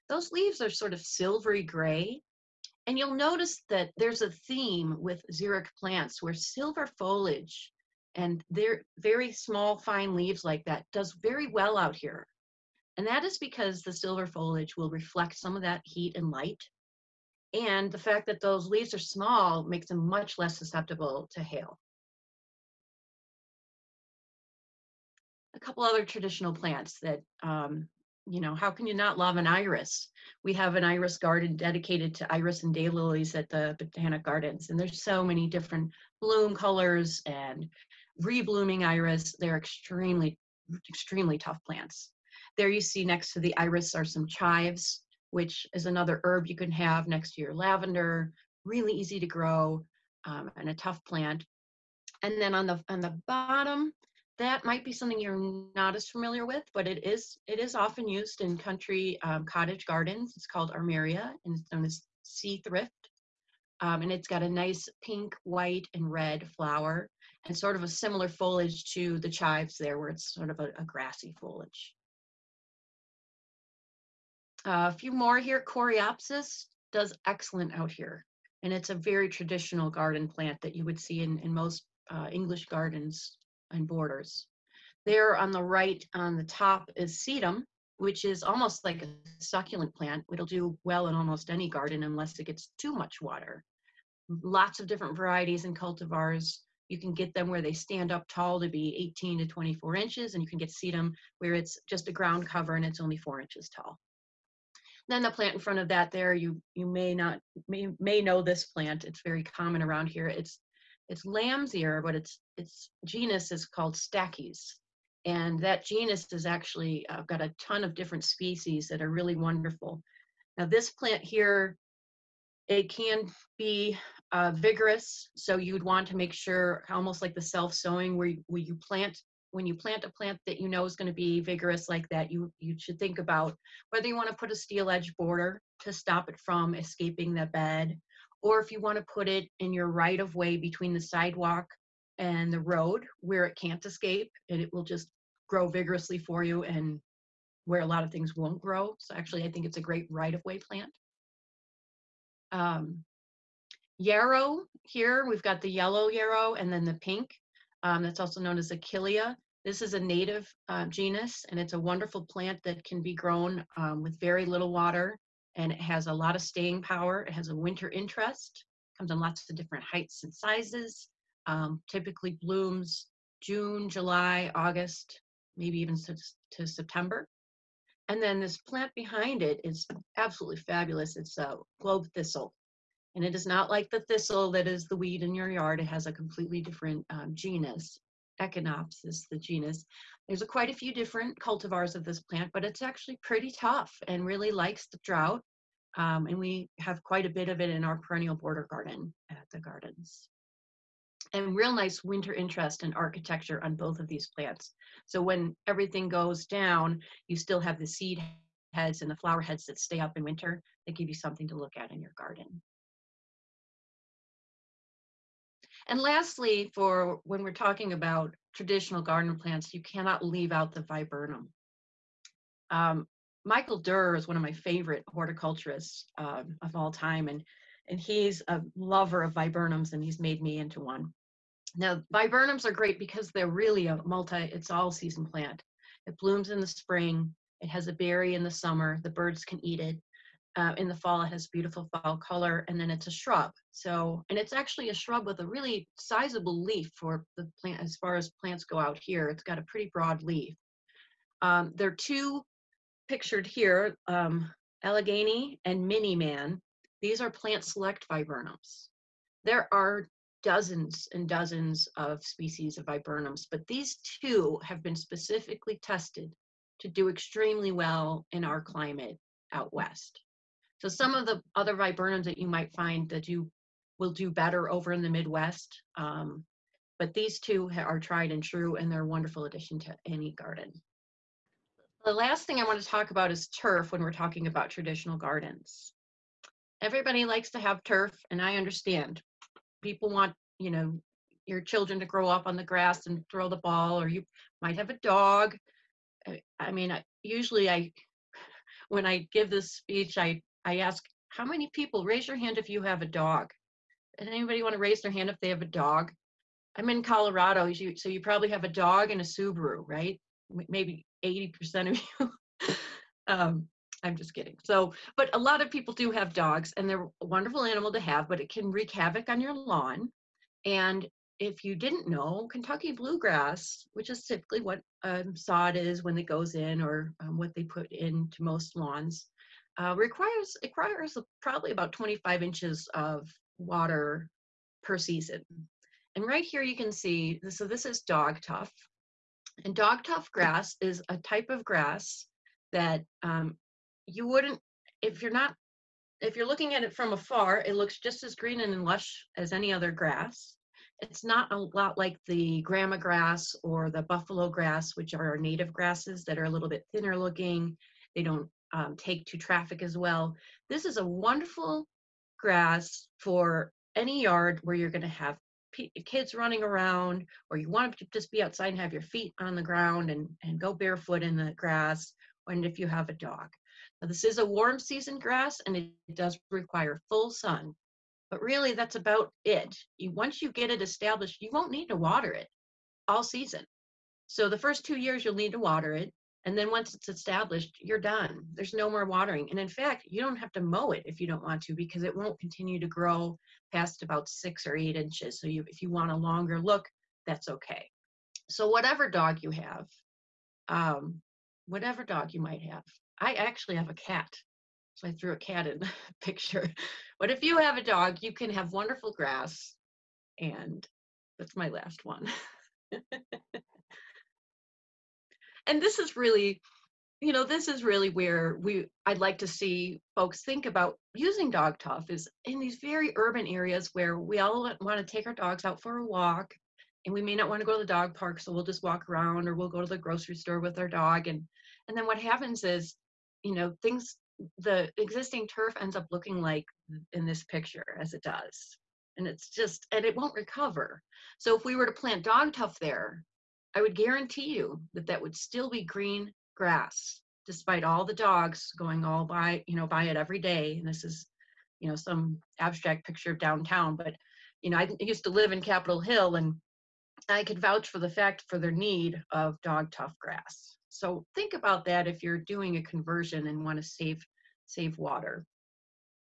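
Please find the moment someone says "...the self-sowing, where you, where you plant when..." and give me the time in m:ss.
2:07.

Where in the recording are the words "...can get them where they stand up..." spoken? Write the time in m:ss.
1:36.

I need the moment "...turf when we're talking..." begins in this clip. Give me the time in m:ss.
4:43.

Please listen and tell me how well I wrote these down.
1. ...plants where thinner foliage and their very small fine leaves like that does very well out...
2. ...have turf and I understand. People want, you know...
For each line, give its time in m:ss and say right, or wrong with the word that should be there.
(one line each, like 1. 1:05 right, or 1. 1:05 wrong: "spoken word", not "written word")
1. 0:05 wrong: "silver", not "thinner"
2. 4:47 right.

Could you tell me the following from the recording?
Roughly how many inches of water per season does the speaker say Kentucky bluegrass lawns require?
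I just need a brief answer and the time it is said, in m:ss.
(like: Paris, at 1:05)
25 inches, at 5:31.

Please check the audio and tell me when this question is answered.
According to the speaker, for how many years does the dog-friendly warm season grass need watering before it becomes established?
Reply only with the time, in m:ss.
6:24.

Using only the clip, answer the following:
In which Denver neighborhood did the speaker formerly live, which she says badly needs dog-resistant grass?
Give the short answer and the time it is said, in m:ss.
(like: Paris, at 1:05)
Capitol Hill, at 7:35.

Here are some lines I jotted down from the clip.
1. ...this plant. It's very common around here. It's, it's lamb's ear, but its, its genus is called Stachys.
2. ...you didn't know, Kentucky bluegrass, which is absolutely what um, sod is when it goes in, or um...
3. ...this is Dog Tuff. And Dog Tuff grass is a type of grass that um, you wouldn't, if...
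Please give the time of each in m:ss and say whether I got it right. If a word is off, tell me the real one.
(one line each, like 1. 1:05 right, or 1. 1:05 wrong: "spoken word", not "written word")
1. 1:48 right
2. 5:21 wrong: "typically", not "absolutely"
3. 5:37 right.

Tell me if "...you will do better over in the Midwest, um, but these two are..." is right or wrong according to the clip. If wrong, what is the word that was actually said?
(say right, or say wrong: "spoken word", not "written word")
right.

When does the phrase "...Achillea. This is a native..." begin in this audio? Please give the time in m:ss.
2:38.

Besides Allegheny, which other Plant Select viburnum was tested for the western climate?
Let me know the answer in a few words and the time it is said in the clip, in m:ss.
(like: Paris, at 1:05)
Mini Man, at 4:15.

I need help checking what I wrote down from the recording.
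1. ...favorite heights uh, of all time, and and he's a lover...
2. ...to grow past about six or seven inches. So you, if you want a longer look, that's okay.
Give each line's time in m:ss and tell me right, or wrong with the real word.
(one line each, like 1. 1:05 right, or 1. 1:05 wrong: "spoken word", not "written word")
1. 3:44 wrong: "horticulturists", not "heights"
2. 6:32 wrong: "eight", not "seven".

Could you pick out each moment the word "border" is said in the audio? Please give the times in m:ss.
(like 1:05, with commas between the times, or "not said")
1:23, 2:15, 3:18.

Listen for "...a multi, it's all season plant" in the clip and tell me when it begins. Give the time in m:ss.
3:53.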